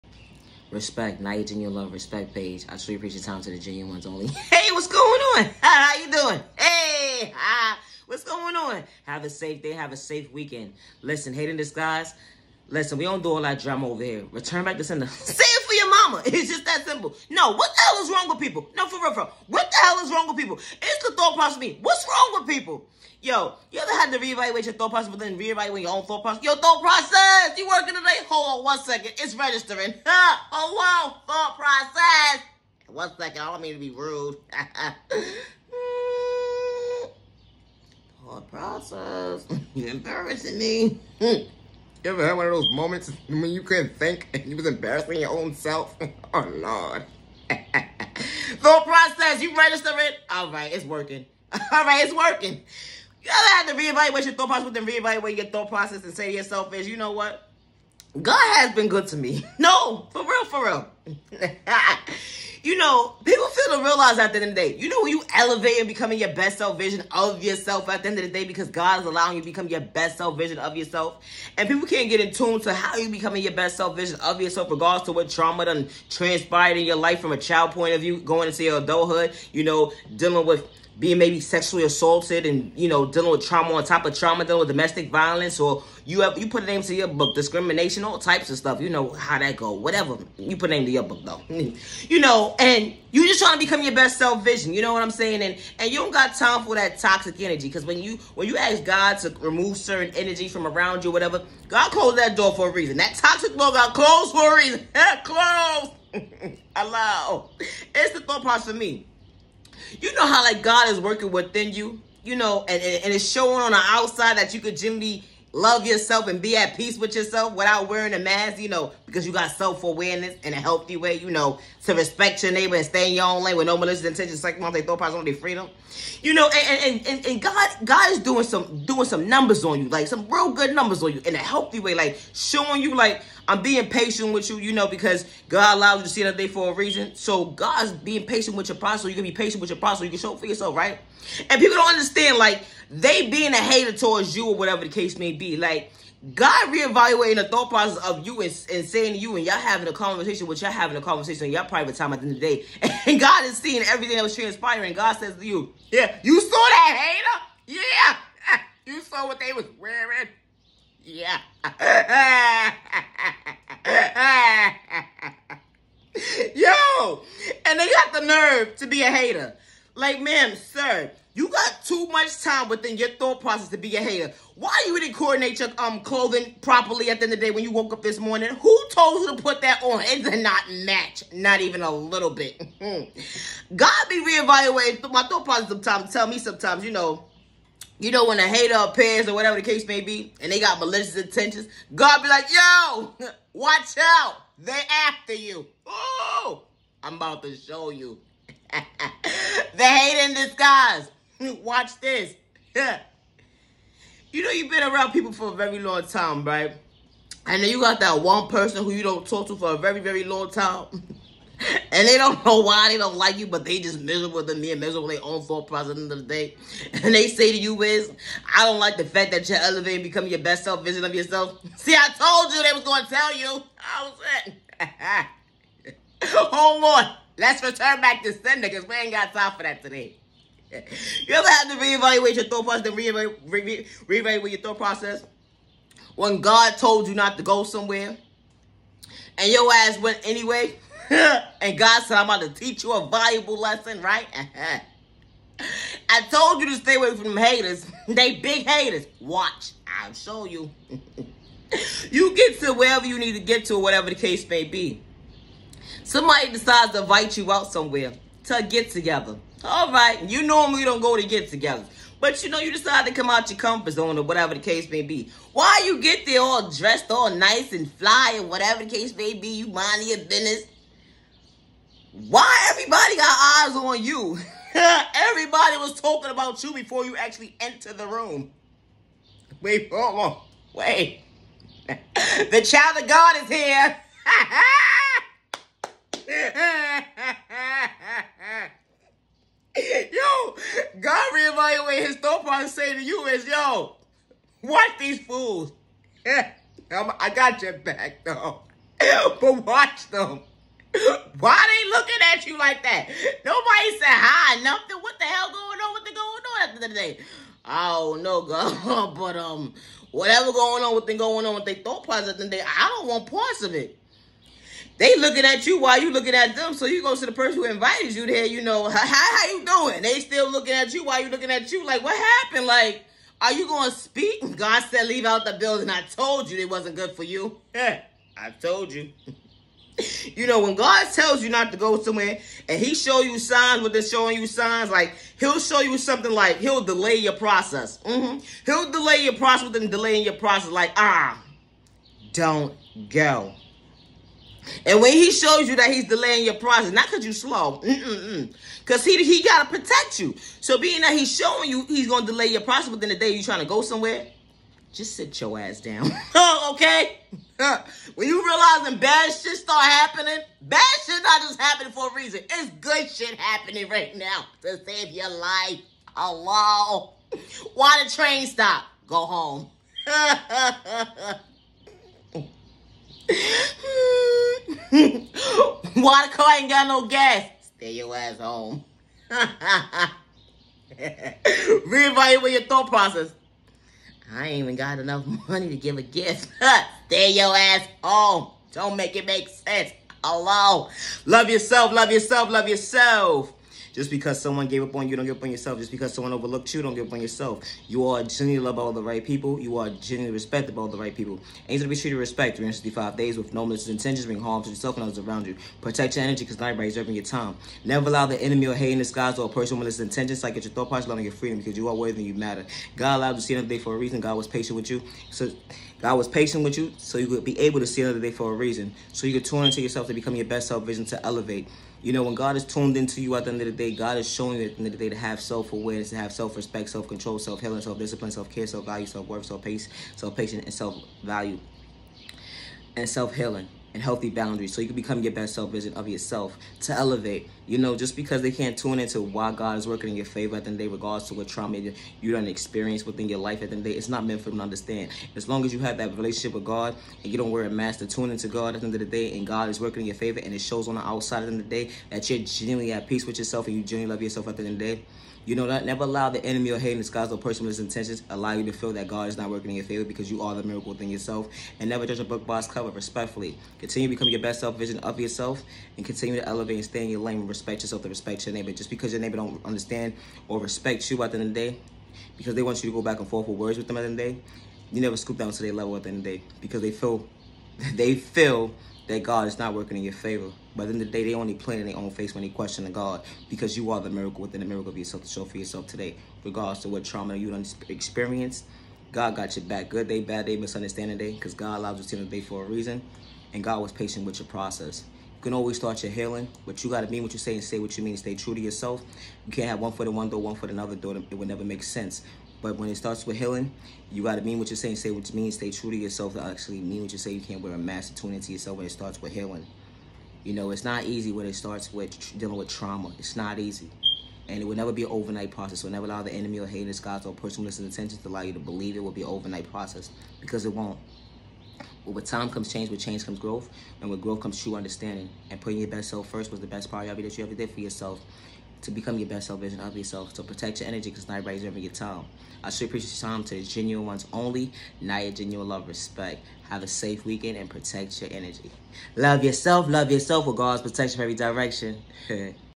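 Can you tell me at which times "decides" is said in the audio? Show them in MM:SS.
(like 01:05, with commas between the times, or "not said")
04:16, 04:22.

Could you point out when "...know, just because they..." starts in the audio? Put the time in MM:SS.
07:17.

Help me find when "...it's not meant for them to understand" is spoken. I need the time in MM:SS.
07:23.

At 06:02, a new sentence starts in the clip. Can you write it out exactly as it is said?
It's good shit happening right now to save your life.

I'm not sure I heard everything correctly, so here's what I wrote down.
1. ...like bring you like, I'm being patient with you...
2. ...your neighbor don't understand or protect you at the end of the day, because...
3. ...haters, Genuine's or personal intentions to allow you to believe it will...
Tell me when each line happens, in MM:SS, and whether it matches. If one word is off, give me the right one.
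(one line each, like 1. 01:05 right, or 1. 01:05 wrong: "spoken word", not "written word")
1. 02:11 wrong: "showing", not "bring"
2. 07:49 wrong: "respect", not "protect"
3. 08:36 wrong: "God", not "Genuine".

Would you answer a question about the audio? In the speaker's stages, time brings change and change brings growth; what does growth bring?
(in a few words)
True understanding.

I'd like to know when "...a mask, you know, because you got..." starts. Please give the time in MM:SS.
01:58.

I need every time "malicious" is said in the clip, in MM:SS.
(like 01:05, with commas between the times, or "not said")
02:03, 03:10, 06:43, 06:49.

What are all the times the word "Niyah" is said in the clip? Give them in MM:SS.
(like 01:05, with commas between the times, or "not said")
00:01.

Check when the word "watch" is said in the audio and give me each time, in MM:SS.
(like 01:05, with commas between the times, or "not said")
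03:13, 03:21, 04:09, 04:54, 04:59.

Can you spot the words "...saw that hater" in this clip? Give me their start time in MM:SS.
02:36.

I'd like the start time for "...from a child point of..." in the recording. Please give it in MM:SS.
01:17.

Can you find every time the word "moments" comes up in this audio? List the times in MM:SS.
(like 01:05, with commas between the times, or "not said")
00:42.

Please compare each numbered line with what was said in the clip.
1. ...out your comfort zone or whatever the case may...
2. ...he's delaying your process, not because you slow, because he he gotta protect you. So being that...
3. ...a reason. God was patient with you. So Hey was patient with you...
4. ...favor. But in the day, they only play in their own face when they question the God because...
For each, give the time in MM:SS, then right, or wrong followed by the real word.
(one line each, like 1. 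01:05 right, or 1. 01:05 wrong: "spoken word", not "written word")
1. 04:23 right
2. 05:45 right
3. 06:53 wrong: "God", not "Hey"
4. 08:00 right.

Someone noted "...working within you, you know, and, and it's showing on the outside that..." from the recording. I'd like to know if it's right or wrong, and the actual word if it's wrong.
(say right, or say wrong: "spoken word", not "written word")
right.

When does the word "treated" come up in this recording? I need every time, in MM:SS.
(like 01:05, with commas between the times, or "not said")
06:41.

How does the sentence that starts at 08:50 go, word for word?
So protect your energy because not everybody's ever your time.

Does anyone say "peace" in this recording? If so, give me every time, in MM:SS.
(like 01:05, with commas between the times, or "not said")
01:56, 07:33.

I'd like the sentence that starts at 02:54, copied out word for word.
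Why you didn't coordinate your um clothing properly at the end of the day when you woke up this morning?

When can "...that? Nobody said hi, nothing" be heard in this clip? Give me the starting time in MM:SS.
05:02.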